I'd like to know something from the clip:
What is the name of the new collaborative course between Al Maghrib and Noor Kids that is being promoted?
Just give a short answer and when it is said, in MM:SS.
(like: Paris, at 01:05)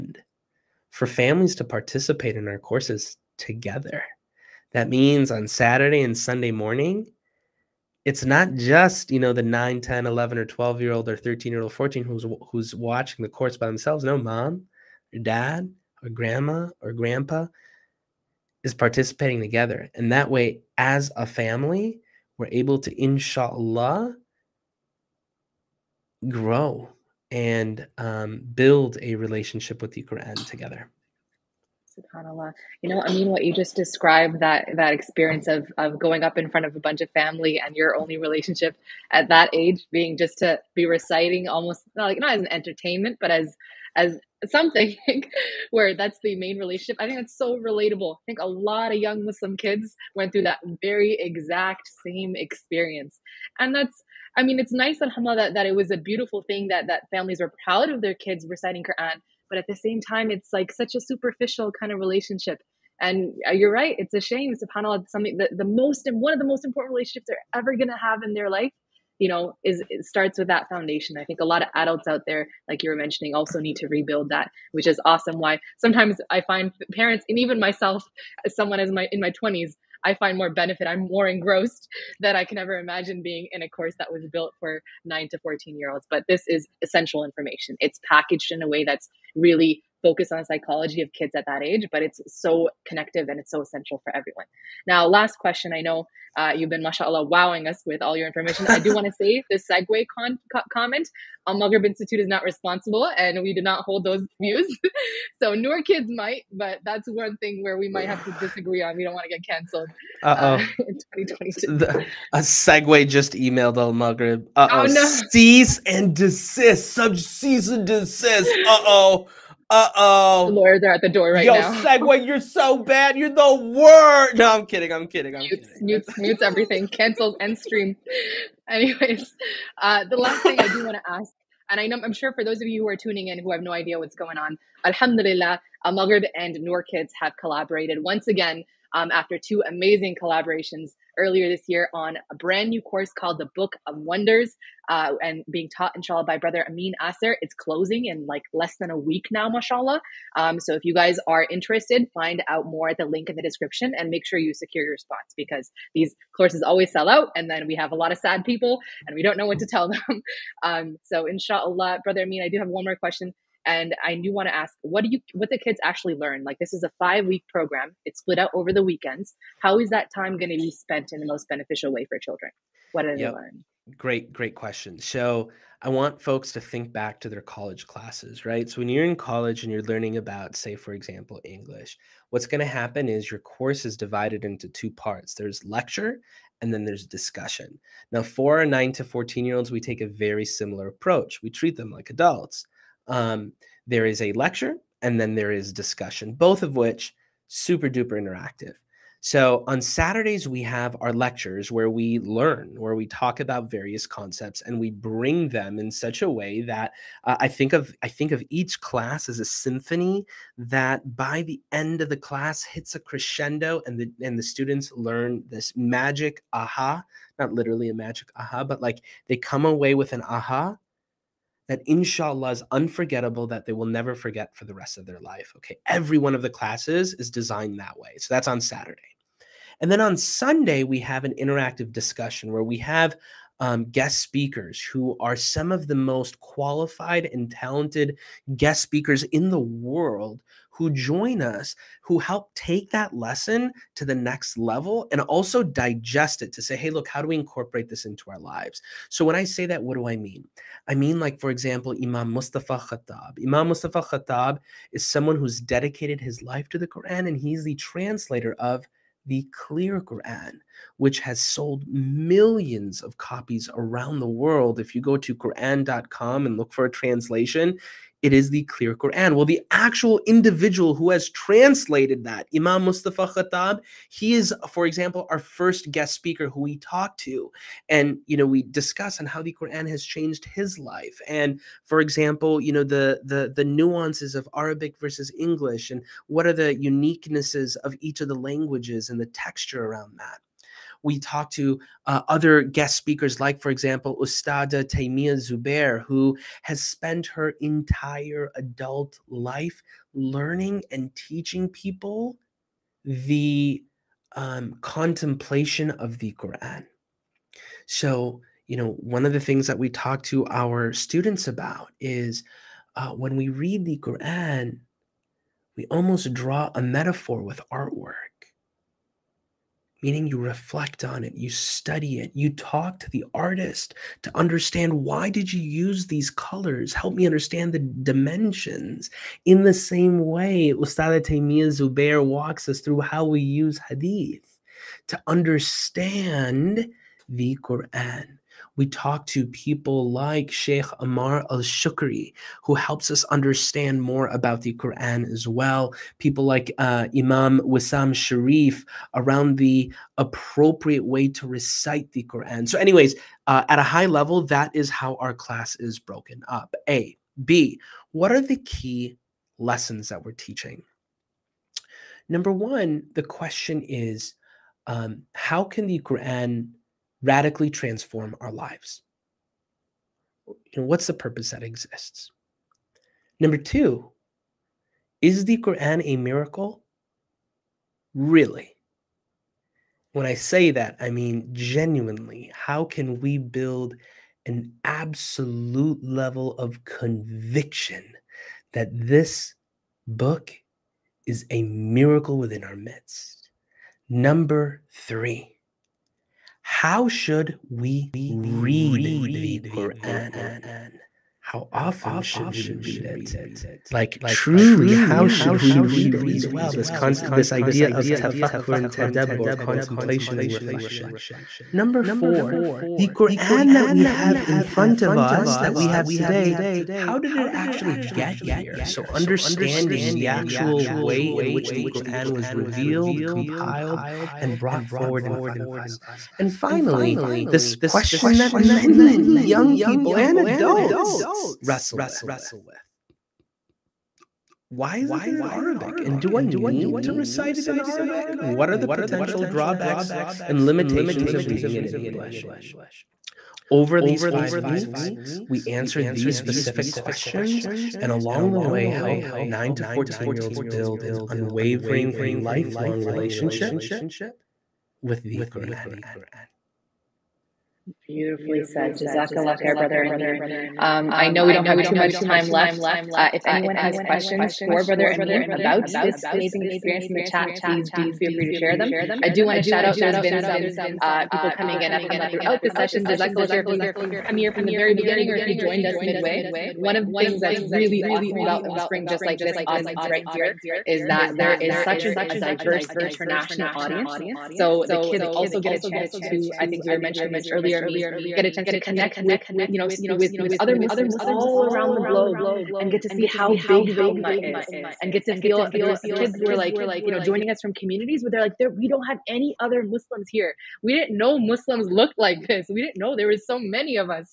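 The Book of Wonders, at 02:23.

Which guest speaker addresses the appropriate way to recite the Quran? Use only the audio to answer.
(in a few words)
Wisam Sharieff.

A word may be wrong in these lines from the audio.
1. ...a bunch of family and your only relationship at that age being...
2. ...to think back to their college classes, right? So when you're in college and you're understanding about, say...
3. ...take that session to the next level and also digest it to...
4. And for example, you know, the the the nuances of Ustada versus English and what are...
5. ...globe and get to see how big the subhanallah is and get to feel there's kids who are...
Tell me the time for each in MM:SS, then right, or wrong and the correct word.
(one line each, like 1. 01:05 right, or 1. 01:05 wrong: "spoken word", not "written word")
1. 00:36 right
2. 02:56 wrong: "learning", not "understanding"
3. 04:02 wrong: "lesson", not "session"
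4. 04:41 wrong: "Arabic", not "Ustada"
5. 08:12 wrong: "ummah", not "subhanallah".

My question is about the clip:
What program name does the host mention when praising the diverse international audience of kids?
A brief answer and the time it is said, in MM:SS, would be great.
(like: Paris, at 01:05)
Ilm Spring, at 07:58.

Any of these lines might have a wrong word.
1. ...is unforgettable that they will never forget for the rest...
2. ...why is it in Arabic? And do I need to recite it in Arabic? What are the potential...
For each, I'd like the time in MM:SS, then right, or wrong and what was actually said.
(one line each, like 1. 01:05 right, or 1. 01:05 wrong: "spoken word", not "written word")
1. 03:42 right
2. 07:14 right.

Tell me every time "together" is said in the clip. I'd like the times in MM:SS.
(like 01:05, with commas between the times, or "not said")
00:03, 00:19, 00:30.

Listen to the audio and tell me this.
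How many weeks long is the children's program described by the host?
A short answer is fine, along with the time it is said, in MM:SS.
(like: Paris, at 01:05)
5, at 02:46.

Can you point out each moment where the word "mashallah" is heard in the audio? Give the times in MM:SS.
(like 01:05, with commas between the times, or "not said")
01:36, 02:29.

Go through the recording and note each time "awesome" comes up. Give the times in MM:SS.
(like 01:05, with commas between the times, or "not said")
01:15, 07:58.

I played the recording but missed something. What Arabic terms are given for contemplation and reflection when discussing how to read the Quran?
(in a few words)
tafakkur and tadabbur.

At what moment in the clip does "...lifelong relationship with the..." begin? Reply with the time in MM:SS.
07:32.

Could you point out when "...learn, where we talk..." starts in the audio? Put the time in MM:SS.
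03:22.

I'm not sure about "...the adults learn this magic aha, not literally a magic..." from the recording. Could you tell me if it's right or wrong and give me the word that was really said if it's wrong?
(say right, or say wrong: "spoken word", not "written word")
wrong: "students", not "adults".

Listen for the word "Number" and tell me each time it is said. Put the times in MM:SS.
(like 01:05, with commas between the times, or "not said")
06:02, 06:13, 06:34, 06:51.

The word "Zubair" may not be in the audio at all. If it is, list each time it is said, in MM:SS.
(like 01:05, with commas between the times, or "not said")
04:55, 05:31.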